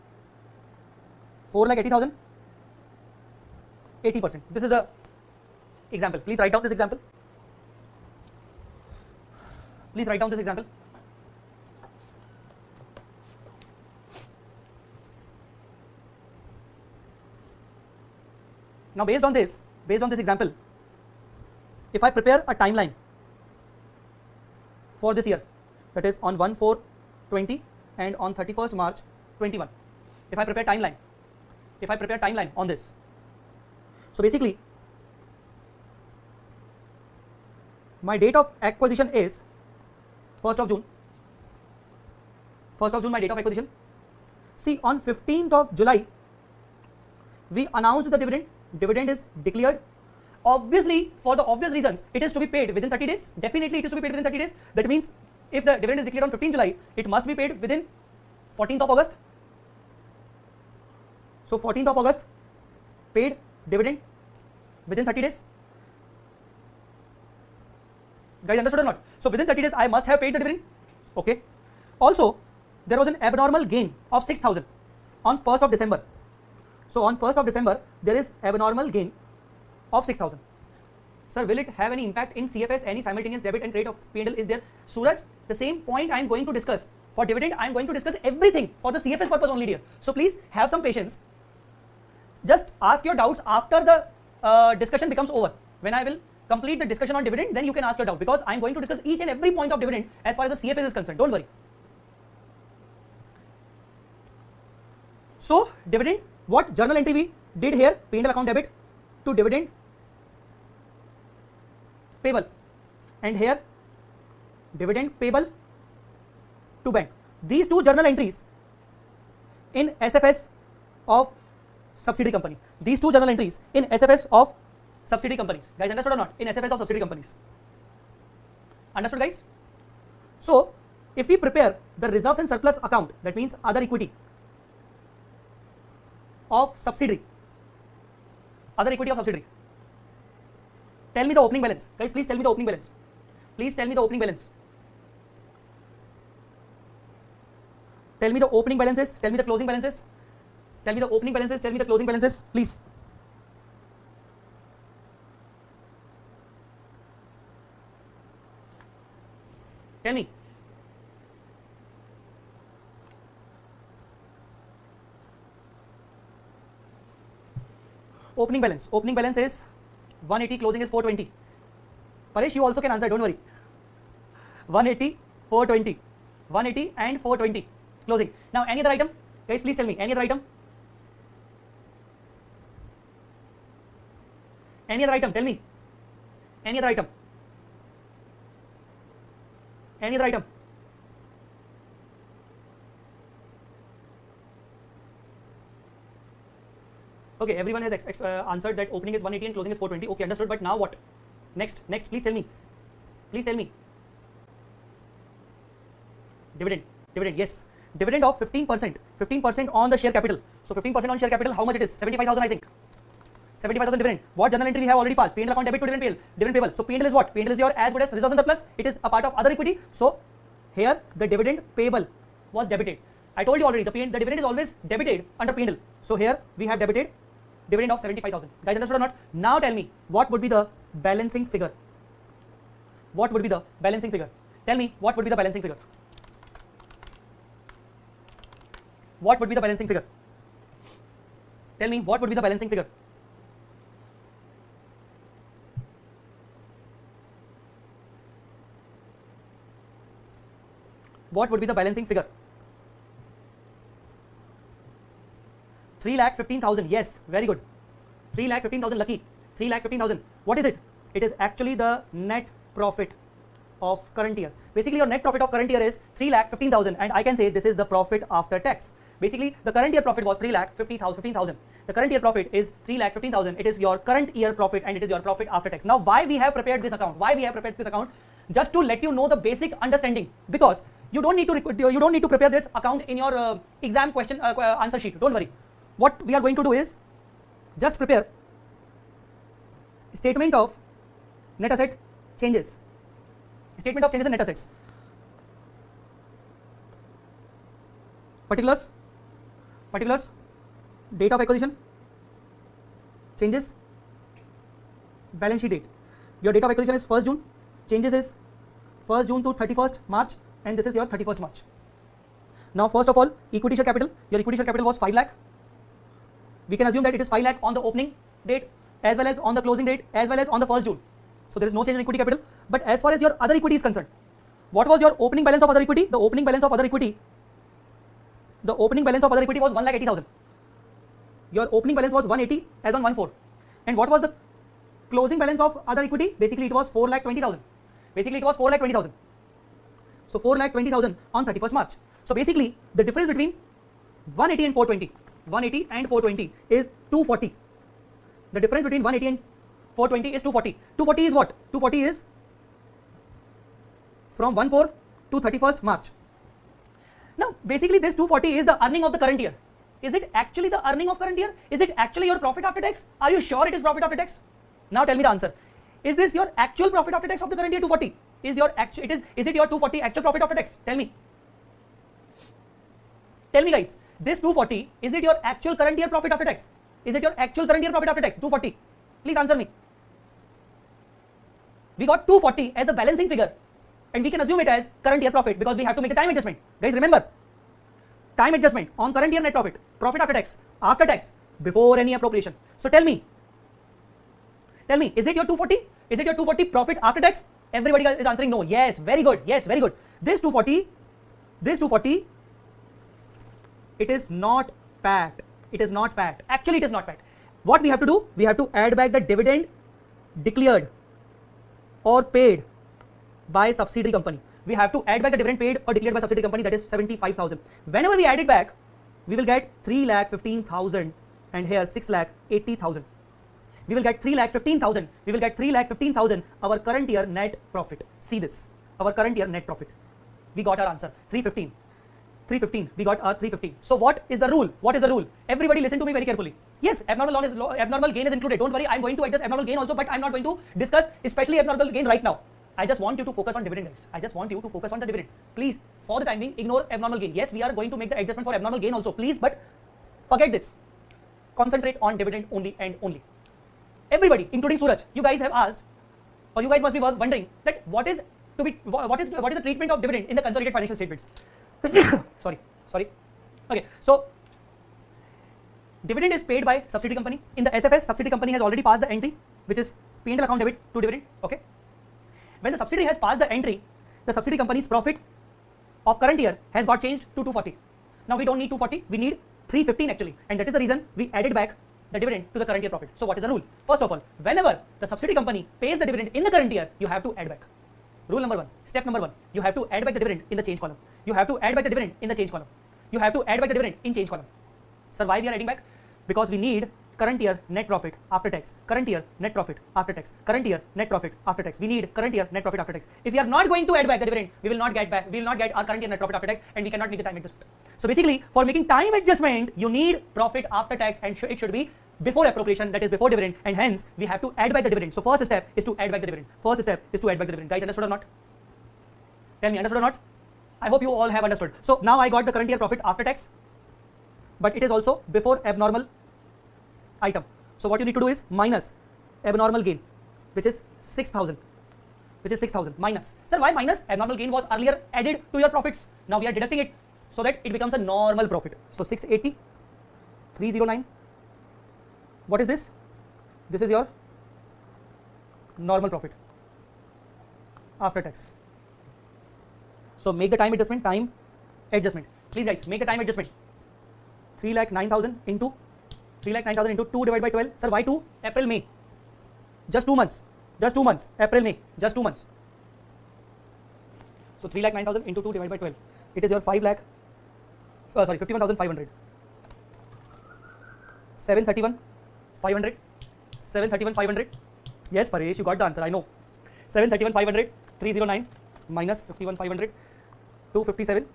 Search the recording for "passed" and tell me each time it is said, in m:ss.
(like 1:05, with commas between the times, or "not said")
3:35, 7:48, 7:53.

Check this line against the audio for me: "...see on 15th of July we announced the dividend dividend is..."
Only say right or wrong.
right.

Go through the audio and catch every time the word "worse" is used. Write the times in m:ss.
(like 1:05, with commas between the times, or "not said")
not said.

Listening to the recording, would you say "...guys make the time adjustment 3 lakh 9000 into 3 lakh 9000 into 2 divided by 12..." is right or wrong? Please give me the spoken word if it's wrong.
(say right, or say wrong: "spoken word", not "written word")
right.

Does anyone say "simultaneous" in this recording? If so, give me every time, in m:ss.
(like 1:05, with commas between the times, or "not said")
1:23.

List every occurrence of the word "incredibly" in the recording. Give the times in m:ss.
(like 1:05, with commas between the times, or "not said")
not said.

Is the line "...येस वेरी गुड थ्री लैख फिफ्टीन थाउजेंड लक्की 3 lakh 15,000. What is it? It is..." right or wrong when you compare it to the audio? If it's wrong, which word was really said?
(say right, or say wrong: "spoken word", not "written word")
right.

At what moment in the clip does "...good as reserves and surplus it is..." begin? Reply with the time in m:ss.
3:37.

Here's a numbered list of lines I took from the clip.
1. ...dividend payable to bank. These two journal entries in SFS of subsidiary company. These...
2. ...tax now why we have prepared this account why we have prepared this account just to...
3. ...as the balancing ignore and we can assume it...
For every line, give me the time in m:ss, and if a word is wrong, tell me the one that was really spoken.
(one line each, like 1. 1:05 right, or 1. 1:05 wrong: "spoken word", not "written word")
1. 1:54 right
2. 4:35 right
3. 6:22 wrong: "figure", not "ignore".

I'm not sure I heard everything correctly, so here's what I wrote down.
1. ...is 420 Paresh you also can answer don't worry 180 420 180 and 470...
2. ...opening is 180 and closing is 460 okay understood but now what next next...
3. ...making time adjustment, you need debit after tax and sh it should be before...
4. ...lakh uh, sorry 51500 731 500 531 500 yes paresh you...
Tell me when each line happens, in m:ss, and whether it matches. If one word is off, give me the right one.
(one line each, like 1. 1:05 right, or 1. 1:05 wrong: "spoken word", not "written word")
1. 2:50 wrong: "420", not "470"
2. 3:18 wrong: "420", not "460"
3. 8:28 wrong: "profit", not "debit"
4. 9:26 wrong: "731", not "531".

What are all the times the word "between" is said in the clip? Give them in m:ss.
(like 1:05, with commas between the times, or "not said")
5:43, 5:48.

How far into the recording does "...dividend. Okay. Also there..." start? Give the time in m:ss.
1:10.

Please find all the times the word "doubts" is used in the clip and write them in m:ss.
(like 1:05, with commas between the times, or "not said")
1:33, 1:38.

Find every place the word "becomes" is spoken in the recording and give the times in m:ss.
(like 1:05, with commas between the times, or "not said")
1:35, 8:57.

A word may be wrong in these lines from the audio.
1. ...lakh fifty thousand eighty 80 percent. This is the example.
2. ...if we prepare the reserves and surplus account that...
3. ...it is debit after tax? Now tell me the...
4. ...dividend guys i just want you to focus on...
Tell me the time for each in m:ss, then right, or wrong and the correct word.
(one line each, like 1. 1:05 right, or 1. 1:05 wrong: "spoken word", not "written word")
1. 0:01 wrong: "eighty", not "fifty"
2. 2:11 right
3. 6:03 wrong: "profit", not "debit"
4. 7:23 right.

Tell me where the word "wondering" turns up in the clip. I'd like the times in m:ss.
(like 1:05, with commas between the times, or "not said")
7:37.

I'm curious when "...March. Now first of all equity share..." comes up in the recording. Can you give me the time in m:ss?
5:11.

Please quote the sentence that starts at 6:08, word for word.
Is your actual it is is it your 240 actual profit after tax?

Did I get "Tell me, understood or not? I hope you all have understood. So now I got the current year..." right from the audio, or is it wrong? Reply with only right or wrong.
right.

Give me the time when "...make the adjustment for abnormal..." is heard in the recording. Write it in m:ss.
7:28.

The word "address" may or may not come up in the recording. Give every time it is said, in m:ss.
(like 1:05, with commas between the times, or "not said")
7:19.